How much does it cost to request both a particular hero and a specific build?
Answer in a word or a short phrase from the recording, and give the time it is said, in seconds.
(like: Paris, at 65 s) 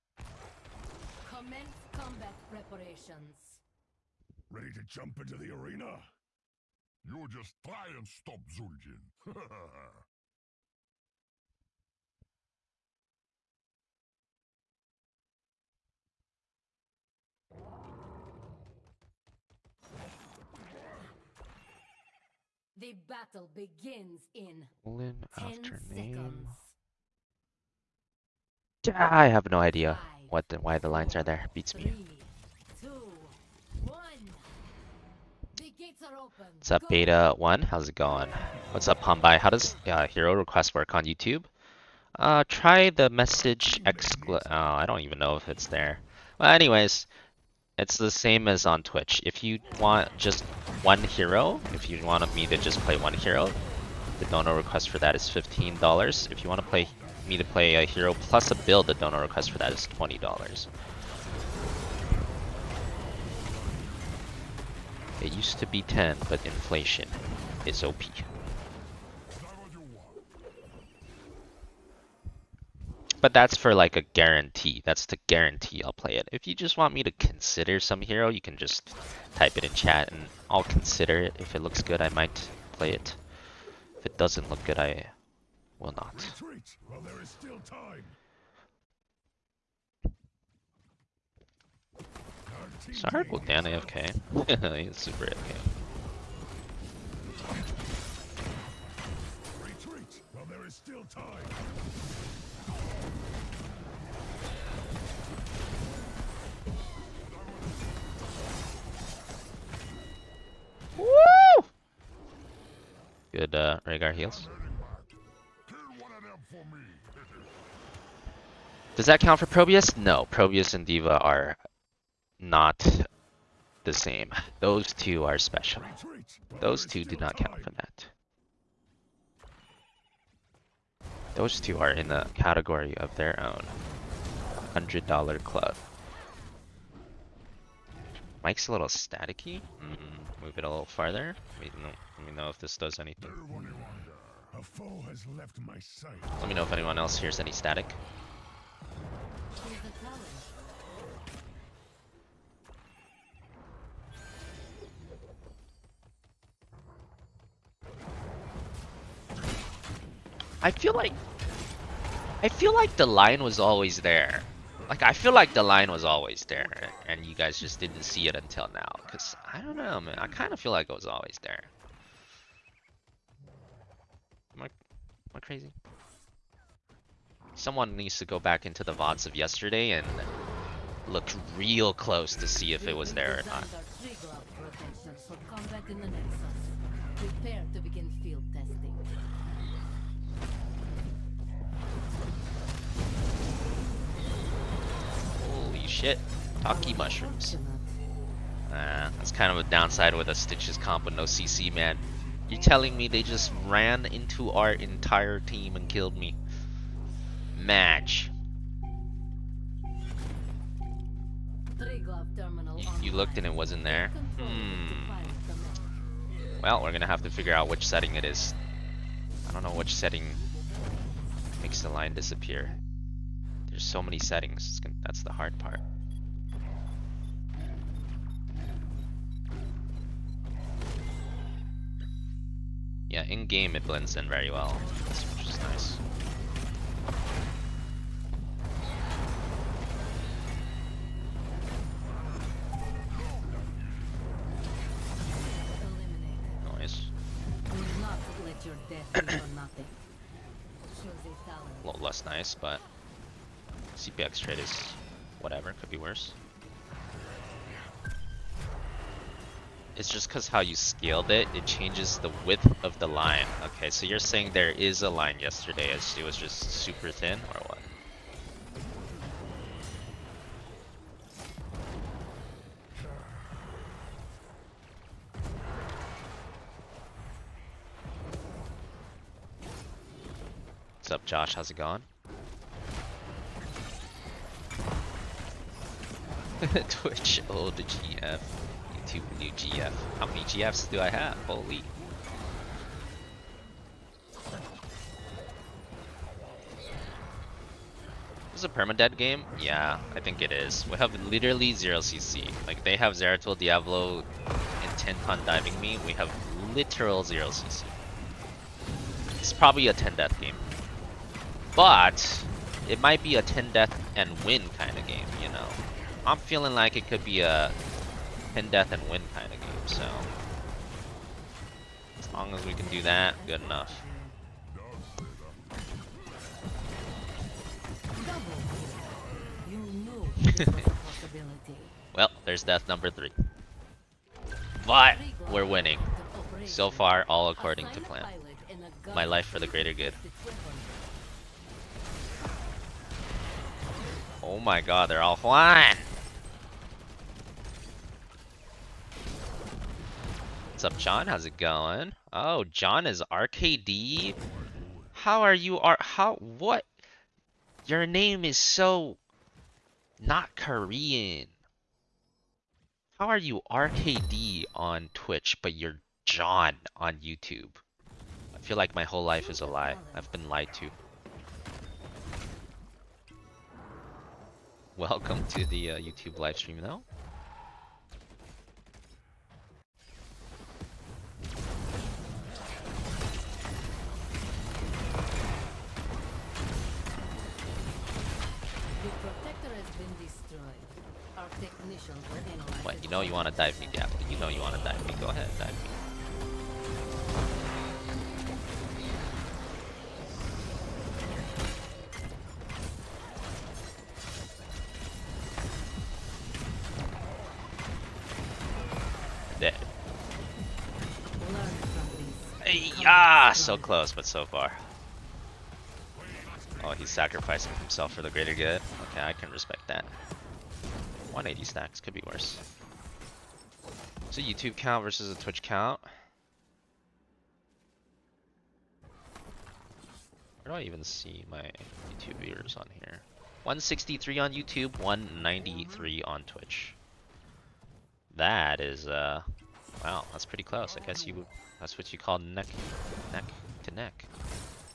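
$20, at 59 s.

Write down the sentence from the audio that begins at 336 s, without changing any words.
So far, all according to plan.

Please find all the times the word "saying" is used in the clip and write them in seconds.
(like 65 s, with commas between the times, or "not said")
264 s.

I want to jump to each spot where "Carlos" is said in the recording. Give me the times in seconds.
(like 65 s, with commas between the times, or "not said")
not said.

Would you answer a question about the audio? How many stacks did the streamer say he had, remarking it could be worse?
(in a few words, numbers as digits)
180.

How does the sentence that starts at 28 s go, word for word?
I have no idea what the, why the lines are there.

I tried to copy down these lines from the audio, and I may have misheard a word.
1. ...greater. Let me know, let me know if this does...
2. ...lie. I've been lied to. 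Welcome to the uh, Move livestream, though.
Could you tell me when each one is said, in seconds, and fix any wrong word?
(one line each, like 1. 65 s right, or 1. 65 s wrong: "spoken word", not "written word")
1. 140 s wrong: "farther", not "greater"
2. 369 s wrong: "YouTube", not "Move".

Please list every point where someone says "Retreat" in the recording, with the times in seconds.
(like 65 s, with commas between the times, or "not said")
86 s.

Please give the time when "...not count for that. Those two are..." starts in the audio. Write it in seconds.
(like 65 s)
127 s.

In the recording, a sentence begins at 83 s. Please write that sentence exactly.
If it doesn't look good, I will not.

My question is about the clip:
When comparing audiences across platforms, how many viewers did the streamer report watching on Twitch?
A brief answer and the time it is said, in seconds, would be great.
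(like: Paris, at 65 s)
193, at 434 s.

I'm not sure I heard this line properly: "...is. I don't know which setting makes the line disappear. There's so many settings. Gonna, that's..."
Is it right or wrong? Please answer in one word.
right.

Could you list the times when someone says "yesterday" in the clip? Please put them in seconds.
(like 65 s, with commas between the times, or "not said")
179 s, 265 s.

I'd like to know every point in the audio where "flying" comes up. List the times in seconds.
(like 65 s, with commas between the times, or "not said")
345 s.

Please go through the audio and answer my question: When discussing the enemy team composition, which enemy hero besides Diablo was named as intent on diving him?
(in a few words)
Zeratul.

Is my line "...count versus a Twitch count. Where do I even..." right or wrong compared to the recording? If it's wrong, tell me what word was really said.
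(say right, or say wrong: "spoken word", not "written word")
right.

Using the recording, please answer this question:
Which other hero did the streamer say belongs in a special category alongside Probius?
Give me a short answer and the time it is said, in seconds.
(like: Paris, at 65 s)
D.Va, at 120 s.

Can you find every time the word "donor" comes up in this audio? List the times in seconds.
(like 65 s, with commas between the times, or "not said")
54 s, 58 s.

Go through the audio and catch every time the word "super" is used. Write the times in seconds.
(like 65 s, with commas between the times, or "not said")
94 s, 266 s.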